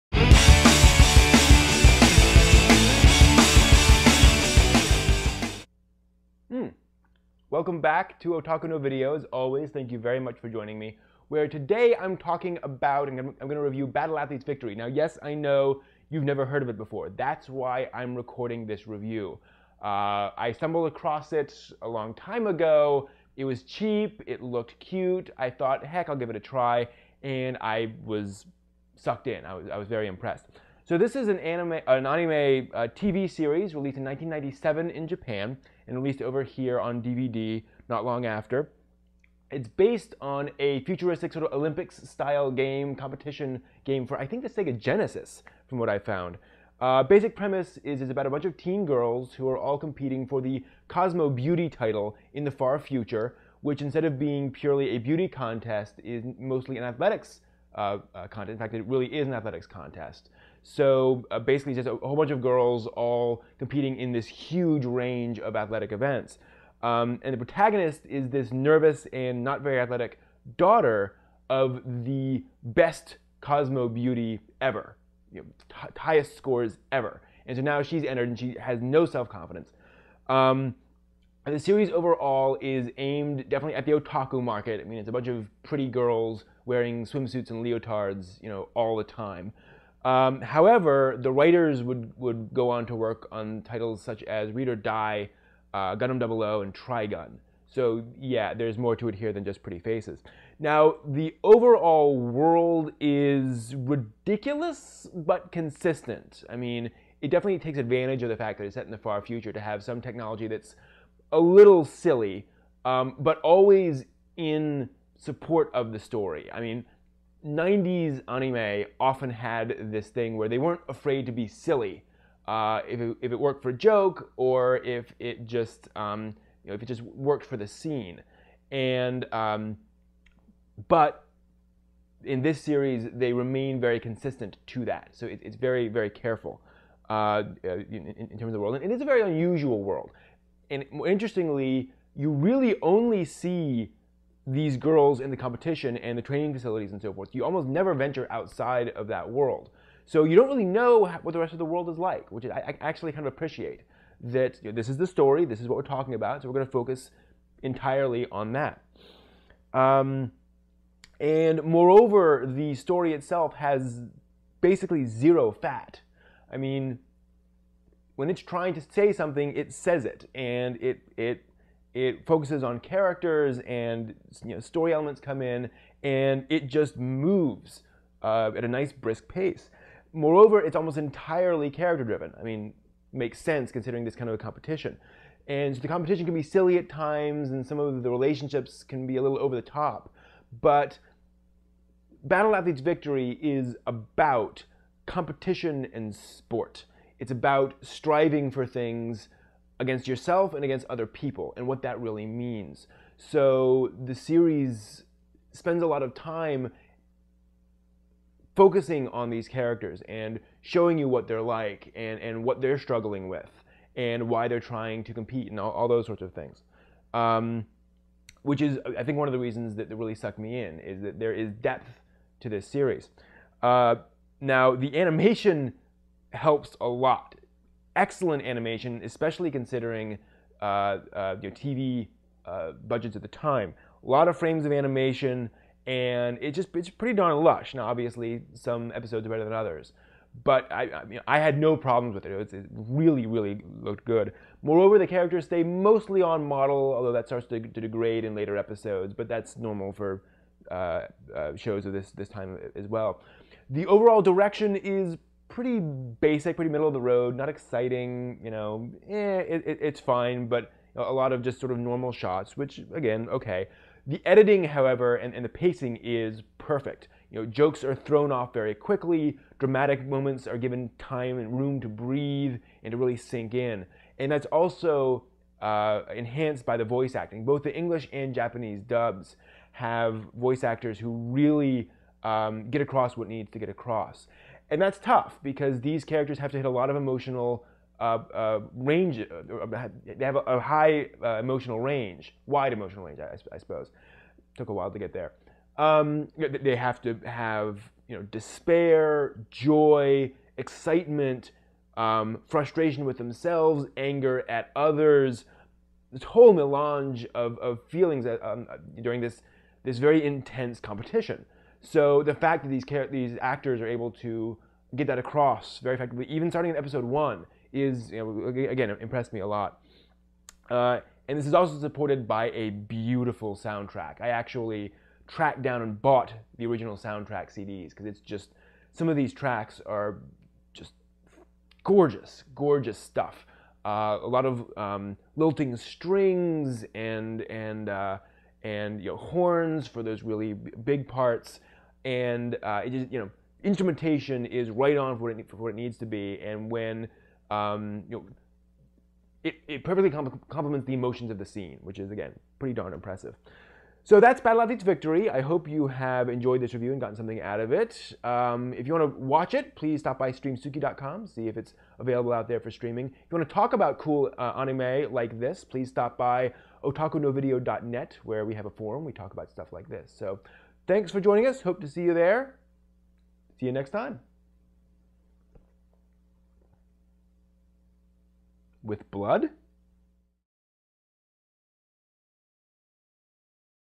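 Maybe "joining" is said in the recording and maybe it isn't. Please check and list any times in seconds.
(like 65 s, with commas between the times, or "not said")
10 s, 371 s.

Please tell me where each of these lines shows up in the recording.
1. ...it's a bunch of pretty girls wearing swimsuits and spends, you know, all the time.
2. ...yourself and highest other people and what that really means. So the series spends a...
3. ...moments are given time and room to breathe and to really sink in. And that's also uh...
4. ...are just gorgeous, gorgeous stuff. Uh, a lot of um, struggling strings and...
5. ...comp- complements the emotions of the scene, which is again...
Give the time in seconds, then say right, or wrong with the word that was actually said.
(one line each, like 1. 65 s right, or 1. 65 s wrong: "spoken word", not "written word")
1. 84 s wrong: "leotards", not "spends"
2. 200 s wrong: "against", not "highest"
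3. 270 s right
4. 329 s wrong: "lilting", not "struggling"
5. 350 s right.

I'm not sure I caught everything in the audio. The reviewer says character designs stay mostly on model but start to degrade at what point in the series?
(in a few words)
later episodes.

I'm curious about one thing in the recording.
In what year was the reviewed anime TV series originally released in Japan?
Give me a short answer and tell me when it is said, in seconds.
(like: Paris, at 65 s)
1997, at 34 s.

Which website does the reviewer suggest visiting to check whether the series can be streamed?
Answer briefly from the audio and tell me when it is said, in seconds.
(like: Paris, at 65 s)
streamsuki.com, at 360 s.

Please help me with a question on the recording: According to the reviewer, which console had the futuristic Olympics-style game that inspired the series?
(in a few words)
Sega Genesis.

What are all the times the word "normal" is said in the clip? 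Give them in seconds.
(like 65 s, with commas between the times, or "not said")
249 s, 261 s.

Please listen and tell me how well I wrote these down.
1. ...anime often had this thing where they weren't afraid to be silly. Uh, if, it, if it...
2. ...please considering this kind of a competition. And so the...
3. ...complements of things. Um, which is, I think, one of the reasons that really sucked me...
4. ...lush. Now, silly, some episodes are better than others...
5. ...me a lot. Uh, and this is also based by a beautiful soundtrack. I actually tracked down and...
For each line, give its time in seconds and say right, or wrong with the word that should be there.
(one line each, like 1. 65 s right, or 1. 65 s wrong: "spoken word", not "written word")
1. 118 s right
2. 183 s wrong: "sense", not "please"
3. 216 s wrong: "sorts", not "complements"
4. 237 s wrong: "obviously", not "silly"
5. 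319 s wrong: "supported", not "based".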